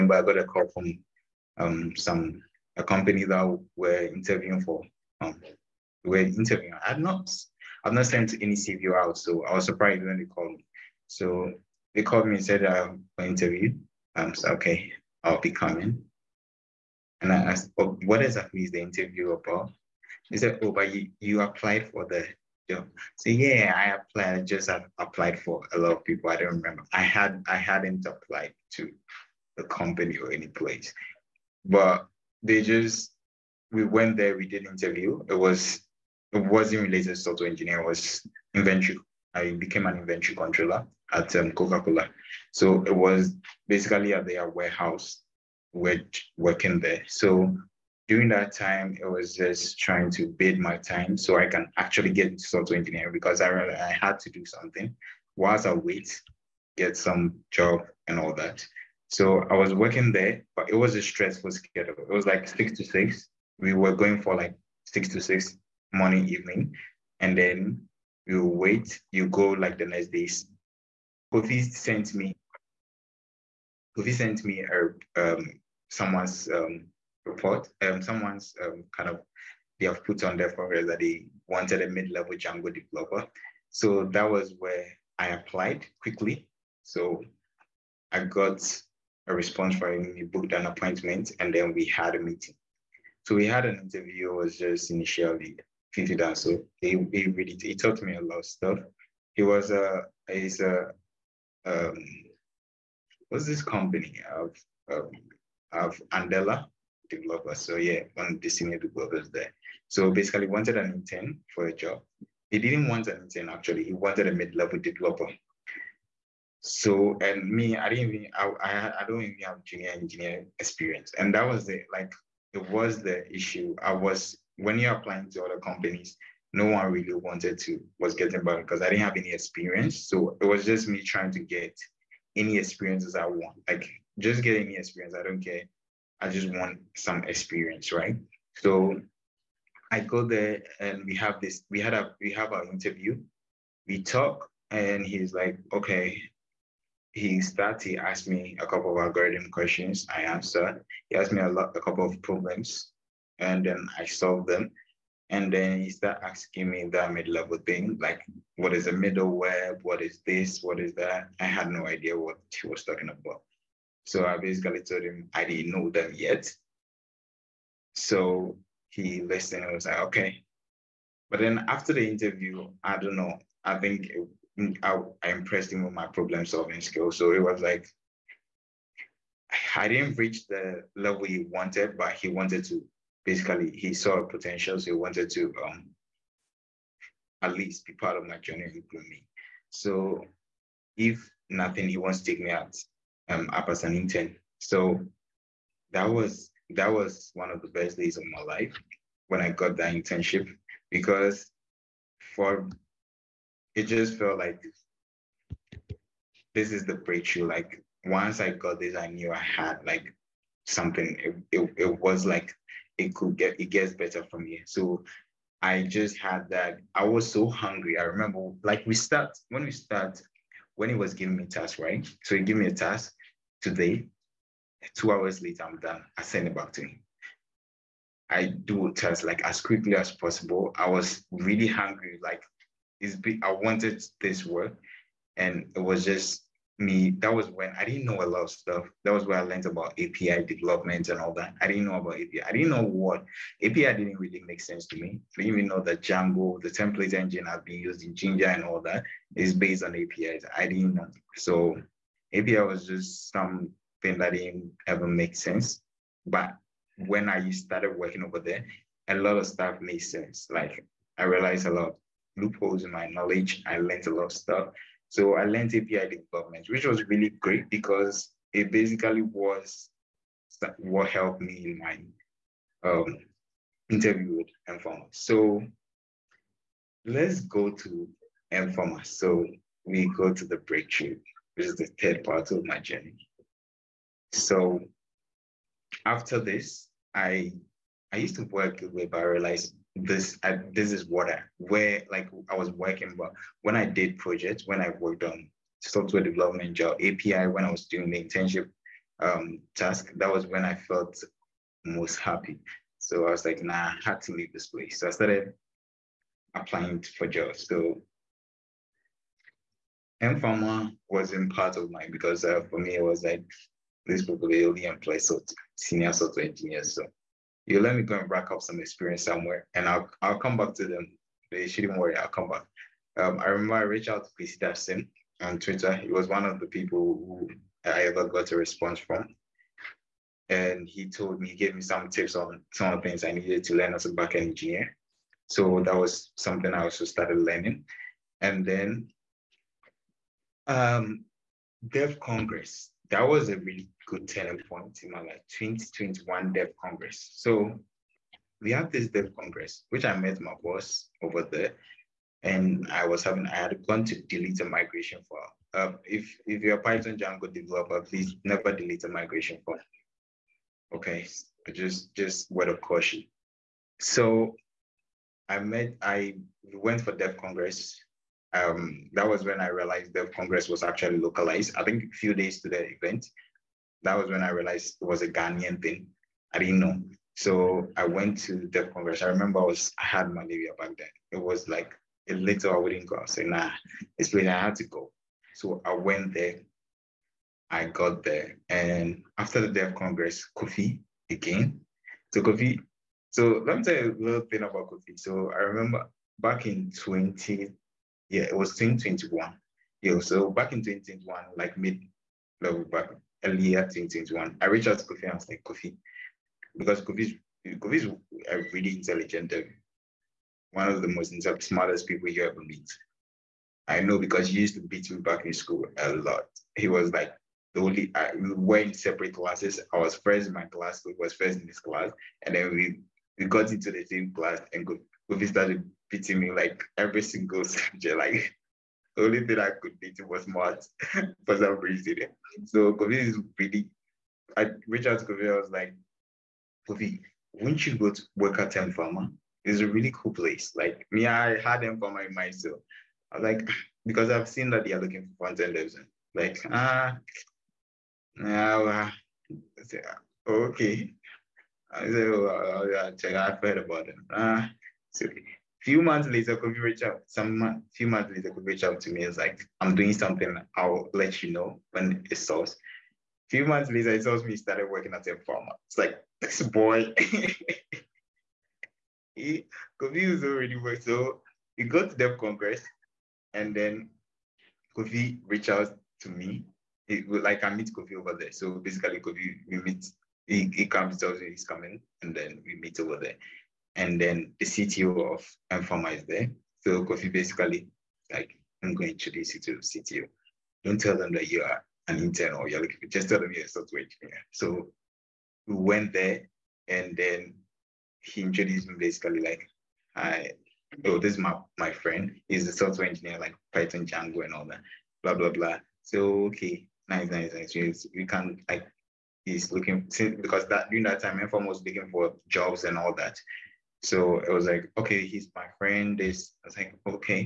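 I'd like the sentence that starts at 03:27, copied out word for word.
Like once I got this, I knew I had like something.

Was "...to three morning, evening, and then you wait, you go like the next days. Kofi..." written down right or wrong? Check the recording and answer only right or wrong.
wrong.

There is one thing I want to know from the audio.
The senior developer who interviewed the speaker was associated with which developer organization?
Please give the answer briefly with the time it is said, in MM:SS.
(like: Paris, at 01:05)
Andela, at 01:46.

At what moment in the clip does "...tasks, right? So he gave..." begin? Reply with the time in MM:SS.
03:41.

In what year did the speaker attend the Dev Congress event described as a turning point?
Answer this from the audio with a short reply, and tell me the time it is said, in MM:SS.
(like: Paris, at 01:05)
2021, at 05:45.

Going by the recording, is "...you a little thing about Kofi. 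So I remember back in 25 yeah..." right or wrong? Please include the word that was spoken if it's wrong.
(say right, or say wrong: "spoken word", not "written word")
wrong: "20", not "25".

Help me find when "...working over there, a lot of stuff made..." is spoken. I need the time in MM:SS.
04:17.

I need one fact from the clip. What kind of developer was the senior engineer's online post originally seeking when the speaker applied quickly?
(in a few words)
mid-level Django developer.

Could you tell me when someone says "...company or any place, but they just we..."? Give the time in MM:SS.
00:29.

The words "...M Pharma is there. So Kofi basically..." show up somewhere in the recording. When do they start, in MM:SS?
08:05.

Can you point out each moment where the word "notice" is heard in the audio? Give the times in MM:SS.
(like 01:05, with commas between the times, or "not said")
not said.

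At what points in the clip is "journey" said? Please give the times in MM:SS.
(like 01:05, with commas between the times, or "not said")
03:08, 04:42.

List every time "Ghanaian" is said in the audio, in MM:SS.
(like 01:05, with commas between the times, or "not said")
06:15.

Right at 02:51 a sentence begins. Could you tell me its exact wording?
But then after the interview, I don't know.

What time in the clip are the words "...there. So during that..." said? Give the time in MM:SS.
00:46.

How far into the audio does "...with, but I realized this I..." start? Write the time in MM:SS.
04:48.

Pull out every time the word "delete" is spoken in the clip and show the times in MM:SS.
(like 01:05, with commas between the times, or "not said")
05:54, 05:58.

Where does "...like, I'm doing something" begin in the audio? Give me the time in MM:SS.
07:39.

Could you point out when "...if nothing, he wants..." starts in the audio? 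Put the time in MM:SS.
03:10.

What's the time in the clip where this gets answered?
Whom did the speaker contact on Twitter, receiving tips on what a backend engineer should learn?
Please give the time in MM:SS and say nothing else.
05:24.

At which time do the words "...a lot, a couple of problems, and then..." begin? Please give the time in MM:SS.
02:31.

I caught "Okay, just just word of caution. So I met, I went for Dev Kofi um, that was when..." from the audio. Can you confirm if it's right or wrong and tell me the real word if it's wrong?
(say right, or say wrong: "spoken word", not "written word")
wrong: "Congress", not "Kofi".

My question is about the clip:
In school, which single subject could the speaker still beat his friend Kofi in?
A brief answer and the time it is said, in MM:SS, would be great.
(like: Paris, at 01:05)
maths, at 07:10.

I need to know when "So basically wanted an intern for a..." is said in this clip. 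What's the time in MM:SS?
01:49.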